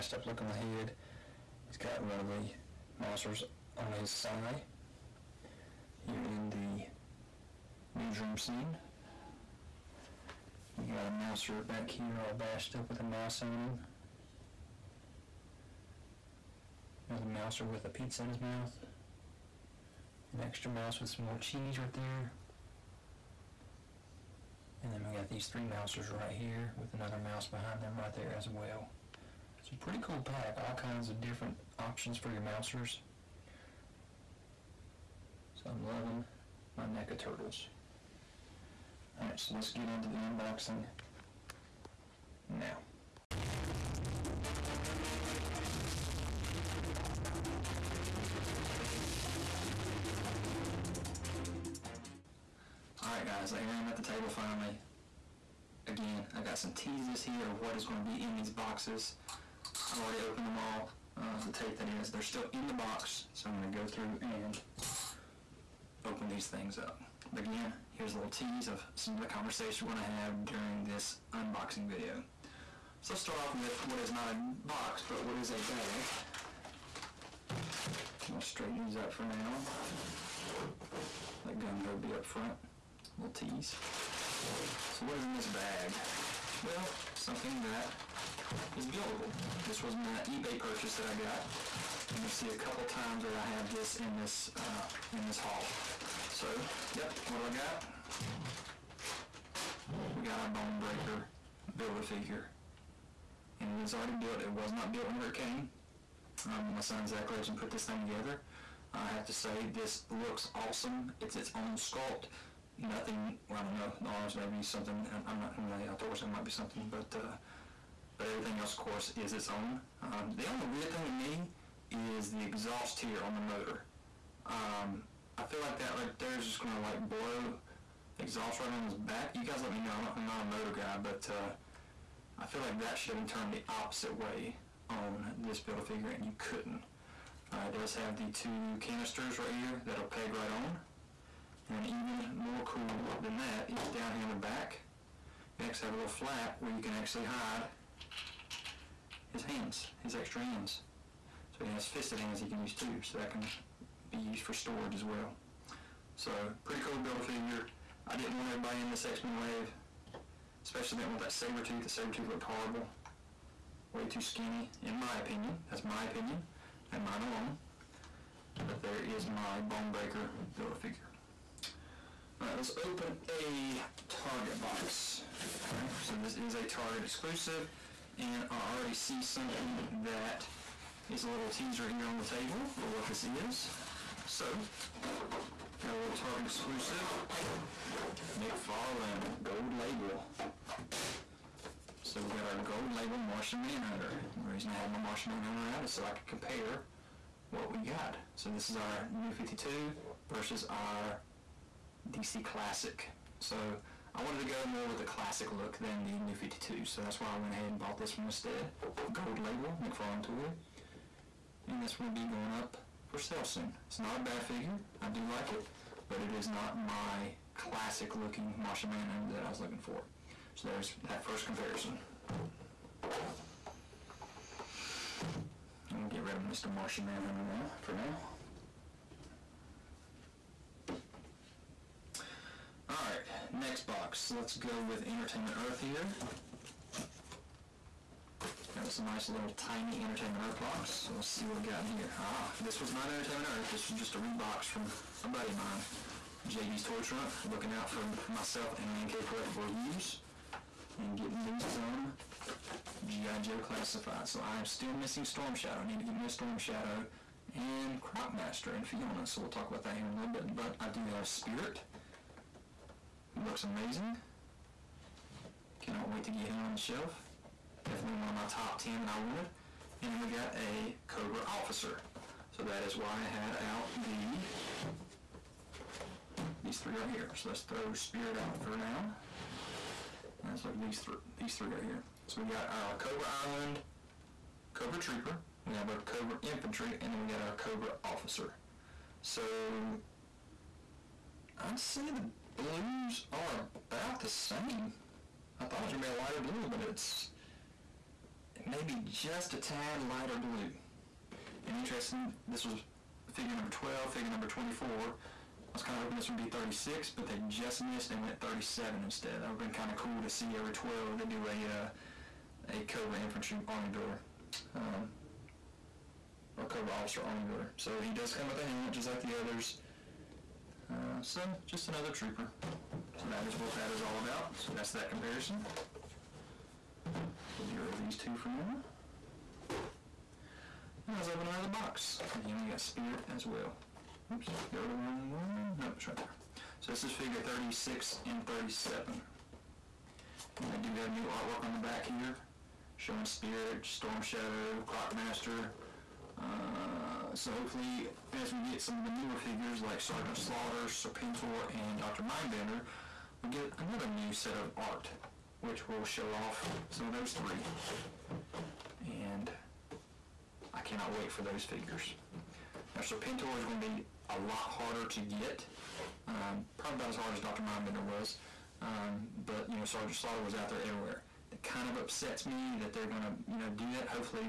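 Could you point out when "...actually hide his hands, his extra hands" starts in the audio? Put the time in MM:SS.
02:26.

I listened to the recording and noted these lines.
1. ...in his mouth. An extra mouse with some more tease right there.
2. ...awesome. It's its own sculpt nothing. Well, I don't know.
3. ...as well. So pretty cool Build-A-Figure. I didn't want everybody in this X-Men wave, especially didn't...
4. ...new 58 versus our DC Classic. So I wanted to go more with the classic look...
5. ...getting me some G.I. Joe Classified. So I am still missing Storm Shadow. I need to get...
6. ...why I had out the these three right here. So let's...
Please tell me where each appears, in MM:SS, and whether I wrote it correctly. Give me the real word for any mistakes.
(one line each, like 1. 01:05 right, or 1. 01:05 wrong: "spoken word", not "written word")
1. 00:18 wrong: "cheese", not "tease"
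2. 01:50 right
3. 02:34 right
4. 03:19 wrong: "52", not "58"
5. 04:11 right
6. 04:32 right.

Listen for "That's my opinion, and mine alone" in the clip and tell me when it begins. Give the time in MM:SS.
02:45.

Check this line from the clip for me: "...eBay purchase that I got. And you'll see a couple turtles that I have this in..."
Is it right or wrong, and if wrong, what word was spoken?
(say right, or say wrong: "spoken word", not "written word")
wrong: "times", not "turtles".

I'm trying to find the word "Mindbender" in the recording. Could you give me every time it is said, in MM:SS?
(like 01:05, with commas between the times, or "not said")
05:52, 06:07.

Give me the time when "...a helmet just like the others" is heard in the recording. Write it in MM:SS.
05:18.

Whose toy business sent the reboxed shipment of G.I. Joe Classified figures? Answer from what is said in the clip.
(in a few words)
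JB's Toy Trunk.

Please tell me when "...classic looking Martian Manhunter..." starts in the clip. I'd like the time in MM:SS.
03:37.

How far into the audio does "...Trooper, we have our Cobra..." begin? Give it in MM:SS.
04:44.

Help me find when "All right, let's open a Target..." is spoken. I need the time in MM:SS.
02:52.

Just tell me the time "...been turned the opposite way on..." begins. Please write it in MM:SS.
02:13.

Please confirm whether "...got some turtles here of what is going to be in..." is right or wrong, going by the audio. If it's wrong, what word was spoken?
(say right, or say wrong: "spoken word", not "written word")
wrong: "teases", not "turtles".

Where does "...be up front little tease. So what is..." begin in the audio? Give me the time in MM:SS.
01:21.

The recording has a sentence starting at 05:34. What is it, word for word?
Oops, get rid of the wrong one.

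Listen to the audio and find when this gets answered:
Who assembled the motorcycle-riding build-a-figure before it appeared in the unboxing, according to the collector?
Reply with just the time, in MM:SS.
01:47.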